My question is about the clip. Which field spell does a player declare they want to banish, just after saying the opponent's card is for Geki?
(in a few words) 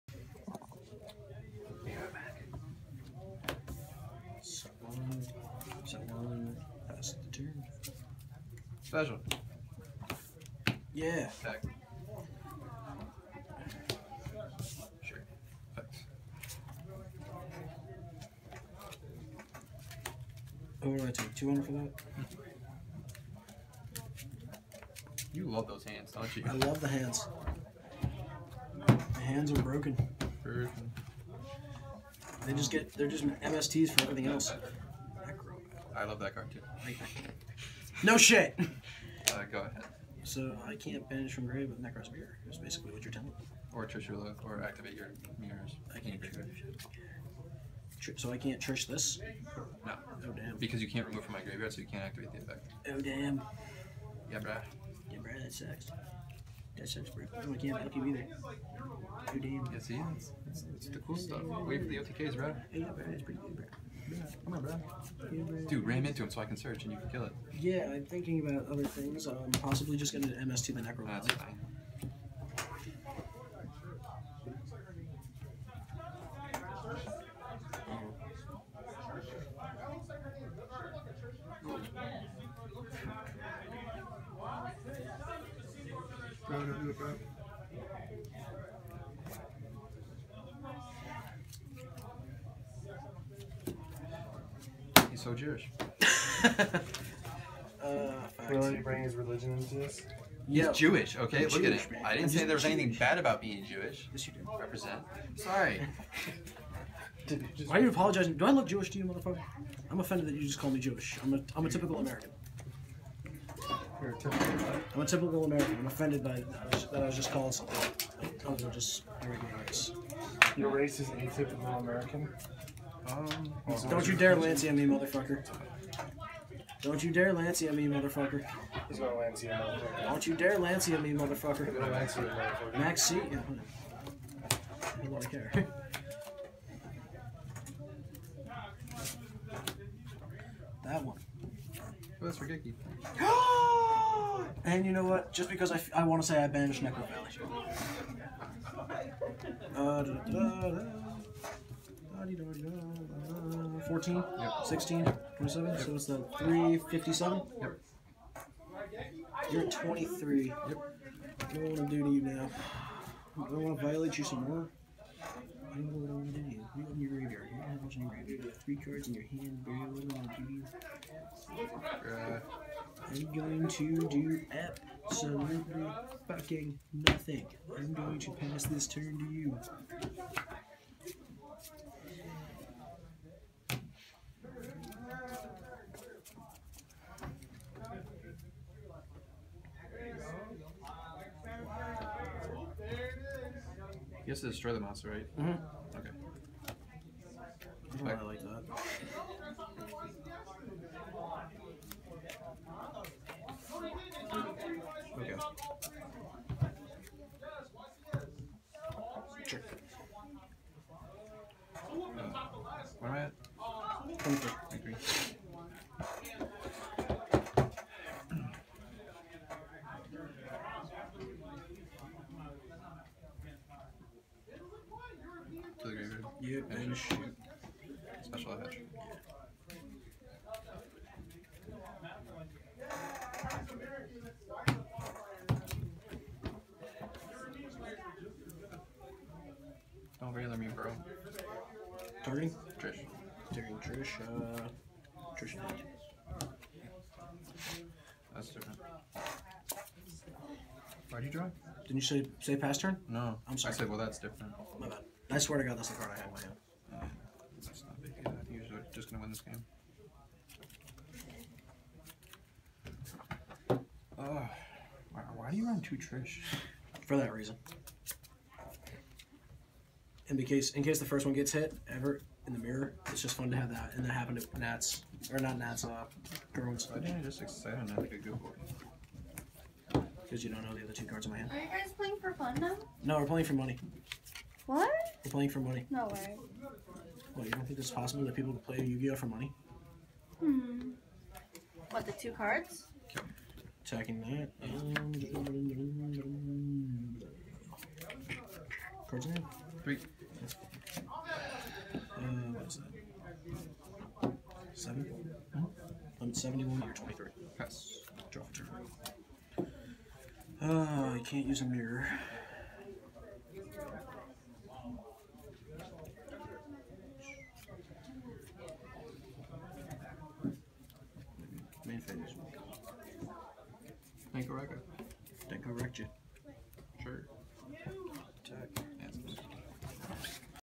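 Necro Valley.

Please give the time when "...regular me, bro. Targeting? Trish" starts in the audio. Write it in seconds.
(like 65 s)
240 s.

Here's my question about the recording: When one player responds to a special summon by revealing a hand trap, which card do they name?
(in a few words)
Maxx C.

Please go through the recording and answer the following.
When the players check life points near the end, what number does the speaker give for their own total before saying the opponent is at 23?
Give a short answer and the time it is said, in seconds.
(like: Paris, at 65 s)
71, at 306 s.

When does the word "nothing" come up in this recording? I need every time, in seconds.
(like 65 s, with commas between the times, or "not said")
176 s.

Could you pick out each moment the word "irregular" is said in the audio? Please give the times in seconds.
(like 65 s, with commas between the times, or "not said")
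119 s.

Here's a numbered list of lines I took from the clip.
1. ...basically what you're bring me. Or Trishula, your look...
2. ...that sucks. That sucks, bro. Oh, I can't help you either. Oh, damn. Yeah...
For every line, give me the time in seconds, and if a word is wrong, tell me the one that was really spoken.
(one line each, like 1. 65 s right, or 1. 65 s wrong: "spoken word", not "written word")
1. 42 s wrong: "telling", not "bring"
2. 55 s right.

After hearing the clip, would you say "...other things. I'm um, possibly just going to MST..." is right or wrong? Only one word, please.
right.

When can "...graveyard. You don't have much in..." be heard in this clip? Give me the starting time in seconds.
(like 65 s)
167 s.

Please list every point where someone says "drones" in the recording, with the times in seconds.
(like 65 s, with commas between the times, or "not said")
276 s.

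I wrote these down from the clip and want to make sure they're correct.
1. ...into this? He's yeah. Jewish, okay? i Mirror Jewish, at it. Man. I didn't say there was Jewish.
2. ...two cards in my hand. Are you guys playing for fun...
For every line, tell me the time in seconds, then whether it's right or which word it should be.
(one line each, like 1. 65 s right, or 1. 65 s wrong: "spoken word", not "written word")
1. 99 s wrong: "Look", not "Mirror"
2. 280 s right.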